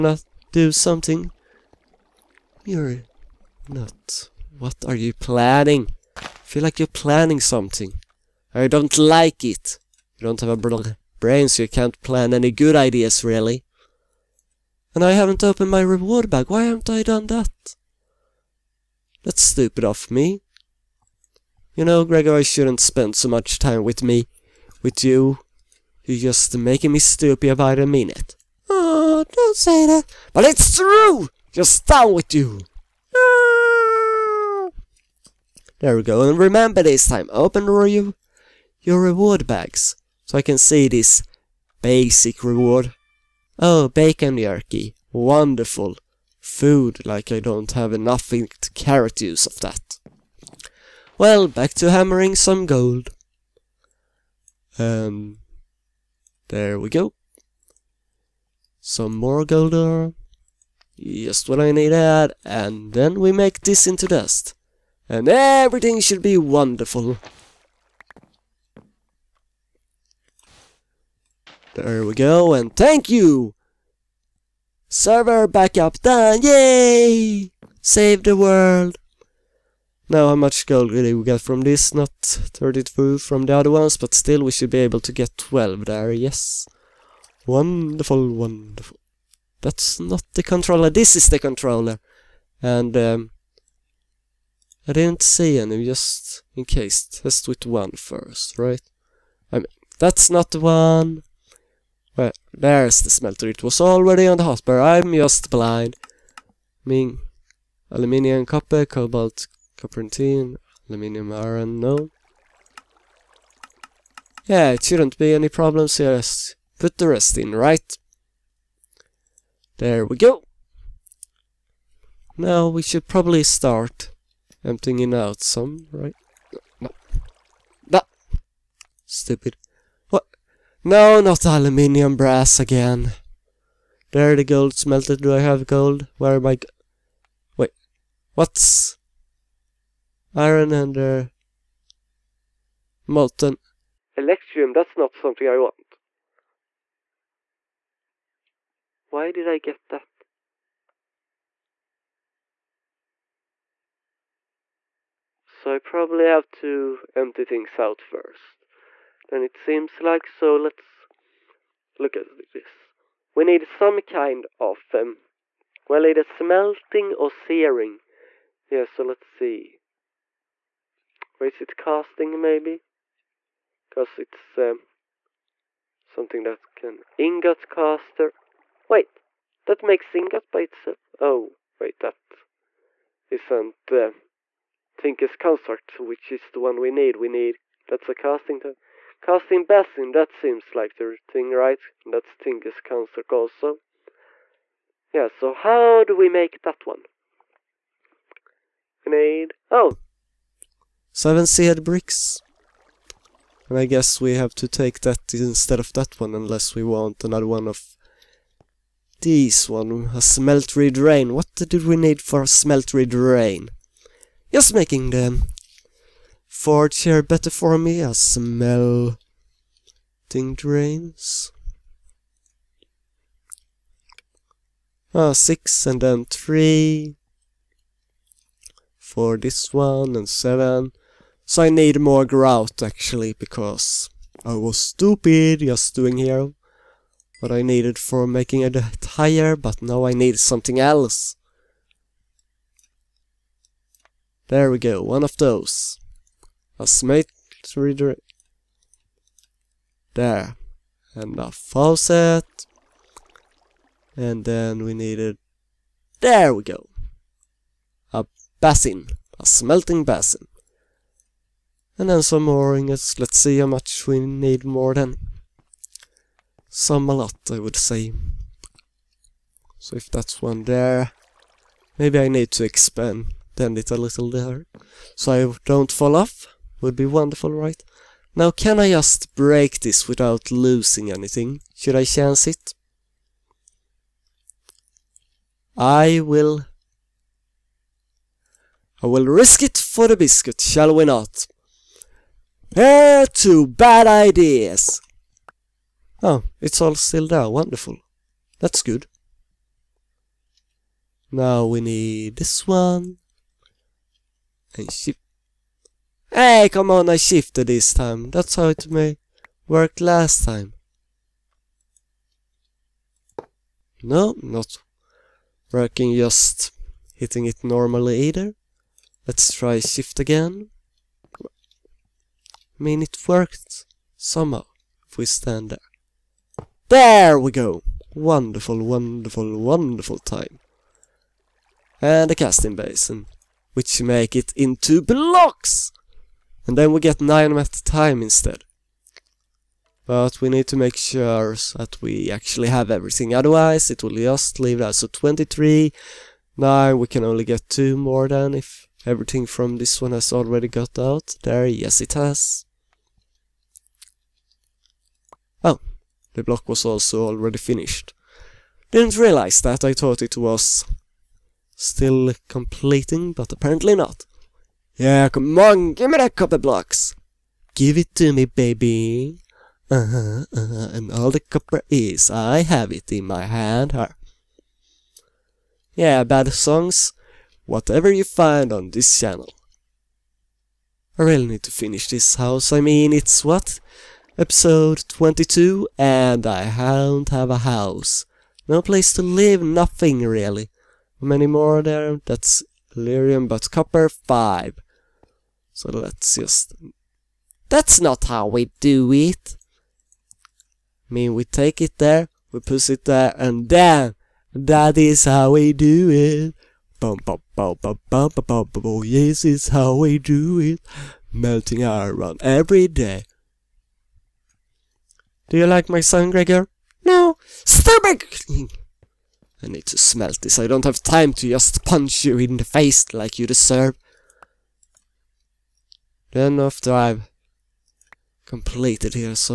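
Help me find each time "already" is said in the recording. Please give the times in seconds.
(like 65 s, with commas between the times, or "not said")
103 s, 350 s, 357 s.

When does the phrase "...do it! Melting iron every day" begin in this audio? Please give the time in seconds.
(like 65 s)
410 s.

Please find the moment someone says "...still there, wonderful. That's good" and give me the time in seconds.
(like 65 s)
296 s.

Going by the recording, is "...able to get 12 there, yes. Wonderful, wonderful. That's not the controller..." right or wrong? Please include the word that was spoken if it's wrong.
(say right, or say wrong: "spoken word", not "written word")
right.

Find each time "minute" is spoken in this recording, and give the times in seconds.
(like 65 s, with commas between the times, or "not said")
27 s.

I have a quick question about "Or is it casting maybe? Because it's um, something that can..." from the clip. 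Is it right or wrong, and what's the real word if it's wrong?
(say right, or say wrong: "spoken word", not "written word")
right.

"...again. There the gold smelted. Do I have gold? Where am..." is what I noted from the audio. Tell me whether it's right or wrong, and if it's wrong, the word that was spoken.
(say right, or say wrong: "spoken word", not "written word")
right.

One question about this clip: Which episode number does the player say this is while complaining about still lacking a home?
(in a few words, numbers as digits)
22.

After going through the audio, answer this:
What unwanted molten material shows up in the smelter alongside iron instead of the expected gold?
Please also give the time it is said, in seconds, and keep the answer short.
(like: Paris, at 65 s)
molten electrum, at 143 s.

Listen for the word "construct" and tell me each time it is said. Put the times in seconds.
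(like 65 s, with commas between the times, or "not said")
185 s, 192 s.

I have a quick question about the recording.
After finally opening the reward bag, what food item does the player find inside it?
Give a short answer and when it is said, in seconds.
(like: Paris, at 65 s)
bacon jerky, at 43 s.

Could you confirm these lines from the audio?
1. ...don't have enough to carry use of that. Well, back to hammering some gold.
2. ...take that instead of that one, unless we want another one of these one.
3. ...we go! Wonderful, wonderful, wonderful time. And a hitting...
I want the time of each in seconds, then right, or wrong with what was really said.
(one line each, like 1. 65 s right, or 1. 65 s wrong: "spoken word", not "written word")
1. 47 s right
2. 204 s right
3. 327 s wrong: "casting", not "hitting".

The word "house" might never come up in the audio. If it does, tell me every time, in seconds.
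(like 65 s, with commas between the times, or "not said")
382 s, 387 s.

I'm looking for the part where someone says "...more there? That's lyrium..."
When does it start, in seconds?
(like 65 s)
391 s.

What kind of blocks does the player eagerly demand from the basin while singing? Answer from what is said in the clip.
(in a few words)
copper blocks.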